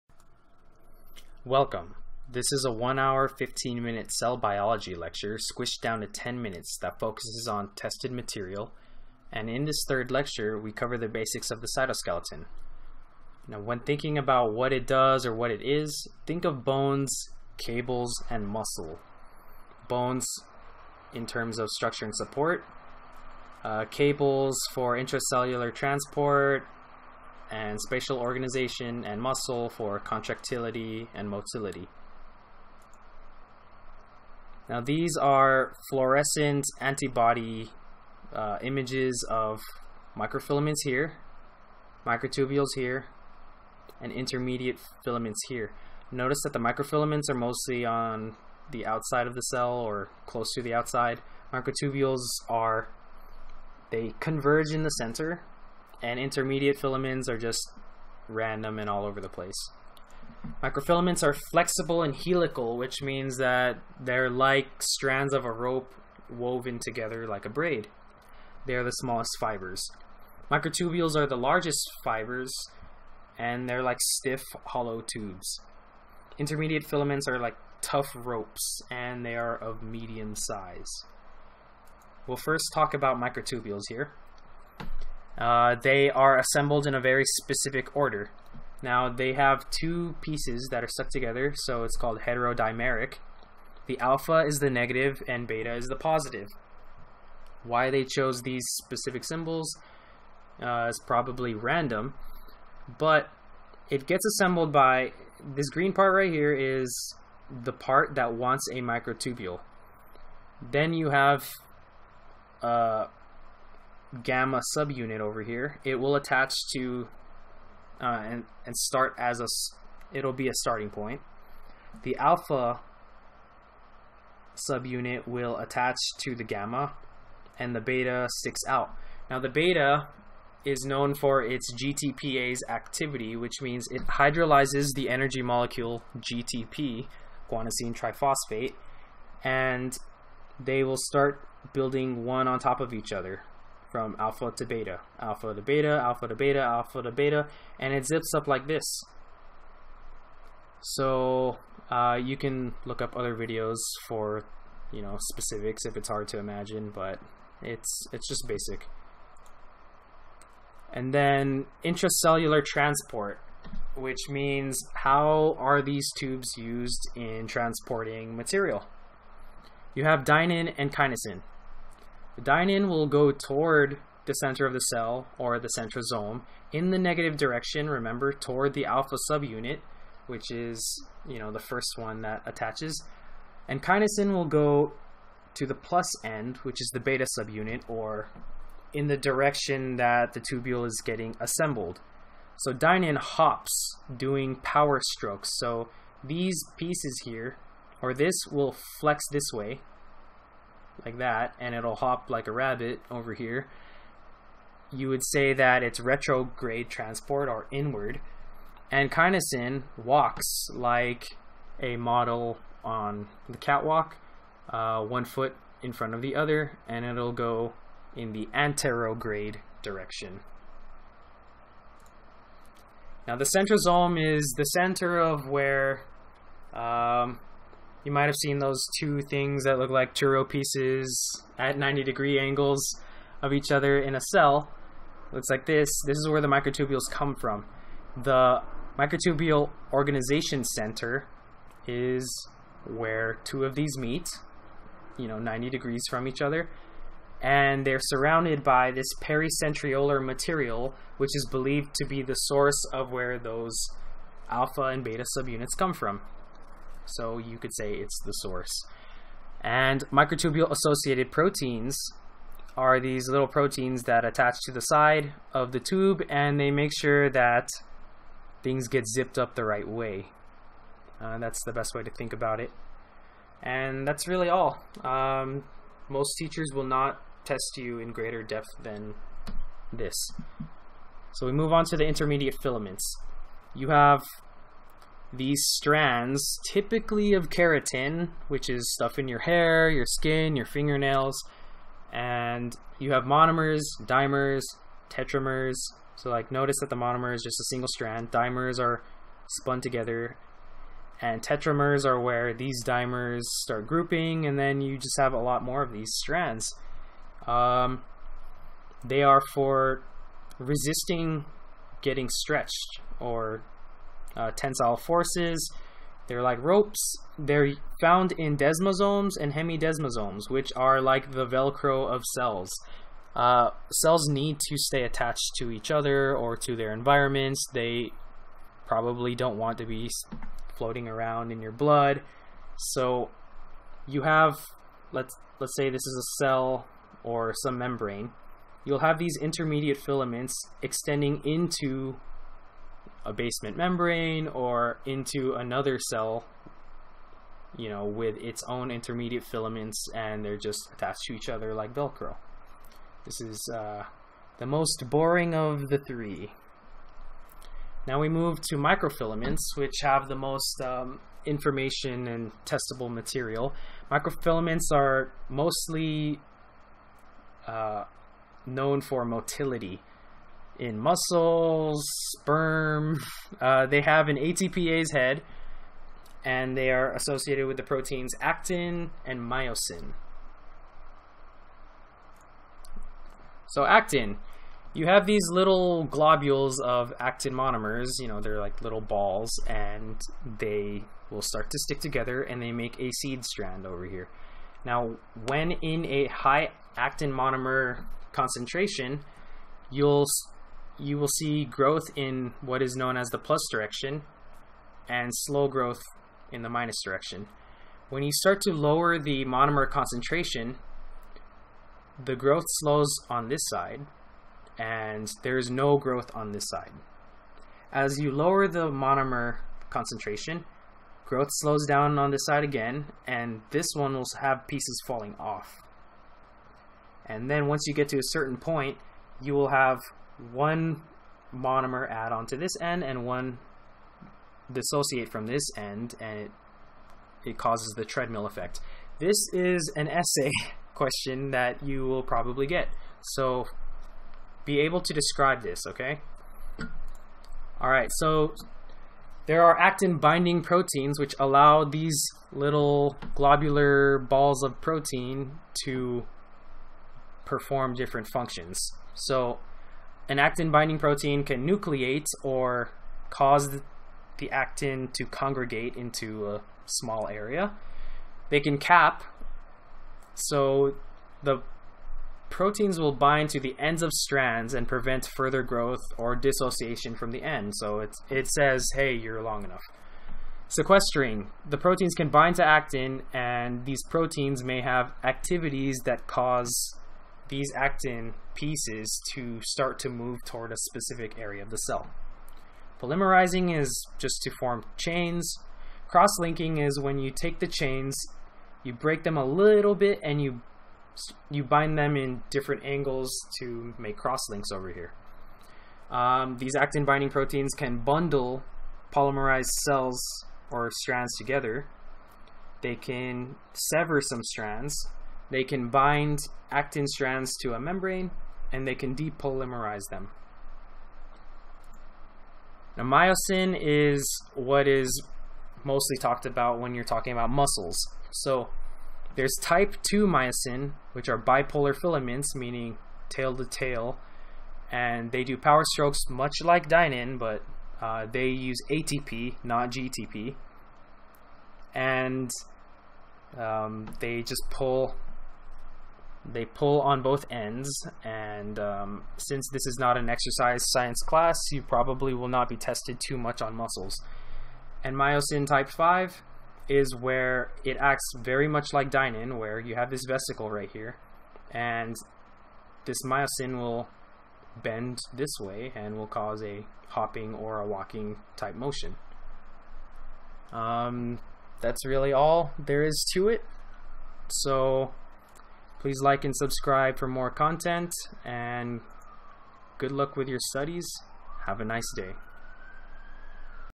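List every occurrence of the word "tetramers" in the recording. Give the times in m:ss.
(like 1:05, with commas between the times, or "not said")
4:55, 5:01.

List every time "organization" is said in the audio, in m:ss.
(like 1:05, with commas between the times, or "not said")
0:28, 3:59.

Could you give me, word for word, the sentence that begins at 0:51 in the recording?
Microtubules are, they converge in the center, and intermediate filaments are just random and all over the place.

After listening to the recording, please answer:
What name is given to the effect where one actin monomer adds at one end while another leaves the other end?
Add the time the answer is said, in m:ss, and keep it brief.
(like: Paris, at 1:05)
Treadmill effect, at 7:18.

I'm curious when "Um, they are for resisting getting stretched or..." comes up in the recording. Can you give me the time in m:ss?
5:07.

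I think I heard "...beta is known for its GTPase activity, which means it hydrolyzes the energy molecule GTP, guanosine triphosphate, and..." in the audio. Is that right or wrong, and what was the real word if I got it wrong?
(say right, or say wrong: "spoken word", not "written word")
right.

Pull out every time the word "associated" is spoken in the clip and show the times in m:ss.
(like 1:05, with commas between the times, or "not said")
4:20, 6:17.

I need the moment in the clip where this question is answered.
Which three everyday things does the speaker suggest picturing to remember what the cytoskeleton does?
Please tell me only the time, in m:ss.
0:16.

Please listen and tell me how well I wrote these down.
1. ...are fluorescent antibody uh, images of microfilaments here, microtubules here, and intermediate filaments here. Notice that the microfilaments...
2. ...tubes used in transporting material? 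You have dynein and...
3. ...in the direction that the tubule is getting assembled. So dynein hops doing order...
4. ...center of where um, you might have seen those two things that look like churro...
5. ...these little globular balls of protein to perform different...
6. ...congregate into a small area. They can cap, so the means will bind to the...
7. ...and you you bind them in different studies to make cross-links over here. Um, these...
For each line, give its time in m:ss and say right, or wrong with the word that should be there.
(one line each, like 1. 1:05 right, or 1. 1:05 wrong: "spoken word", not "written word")
1. 0:35 right
2. 2:46 right
3. 3:08 wrong: "power", not "order"
4. 3:44 right
5. 7:31 right
6. 7:45 wrong: "proteins", not "means"
7. 8:20 wrong: "angles", not "studies".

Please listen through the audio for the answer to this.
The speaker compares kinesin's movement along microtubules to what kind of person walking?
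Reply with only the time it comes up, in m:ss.
3:31.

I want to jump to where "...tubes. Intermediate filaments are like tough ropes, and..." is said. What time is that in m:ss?
1:15.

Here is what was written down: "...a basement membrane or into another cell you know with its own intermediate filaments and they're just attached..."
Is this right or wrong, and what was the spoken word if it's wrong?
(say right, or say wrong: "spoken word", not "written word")
right.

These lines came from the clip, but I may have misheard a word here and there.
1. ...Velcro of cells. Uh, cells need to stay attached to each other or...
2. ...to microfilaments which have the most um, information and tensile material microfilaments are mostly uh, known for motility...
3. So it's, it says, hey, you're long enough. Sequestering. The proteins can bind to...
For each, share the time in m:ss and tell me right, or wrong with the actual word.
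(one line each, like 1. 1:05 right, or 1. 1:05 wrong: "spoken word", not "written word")
1. 5:21 right
2. 5:58 wrong: "testable", not "tensile"
3. 7:57 right.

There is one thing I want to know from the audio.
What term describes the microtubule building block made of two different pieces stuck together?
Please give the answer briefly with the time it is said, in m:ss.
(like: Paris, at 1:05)
Heterodimeric, at 1:32.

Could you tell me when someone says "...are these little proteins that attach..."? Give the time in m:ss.
4:22.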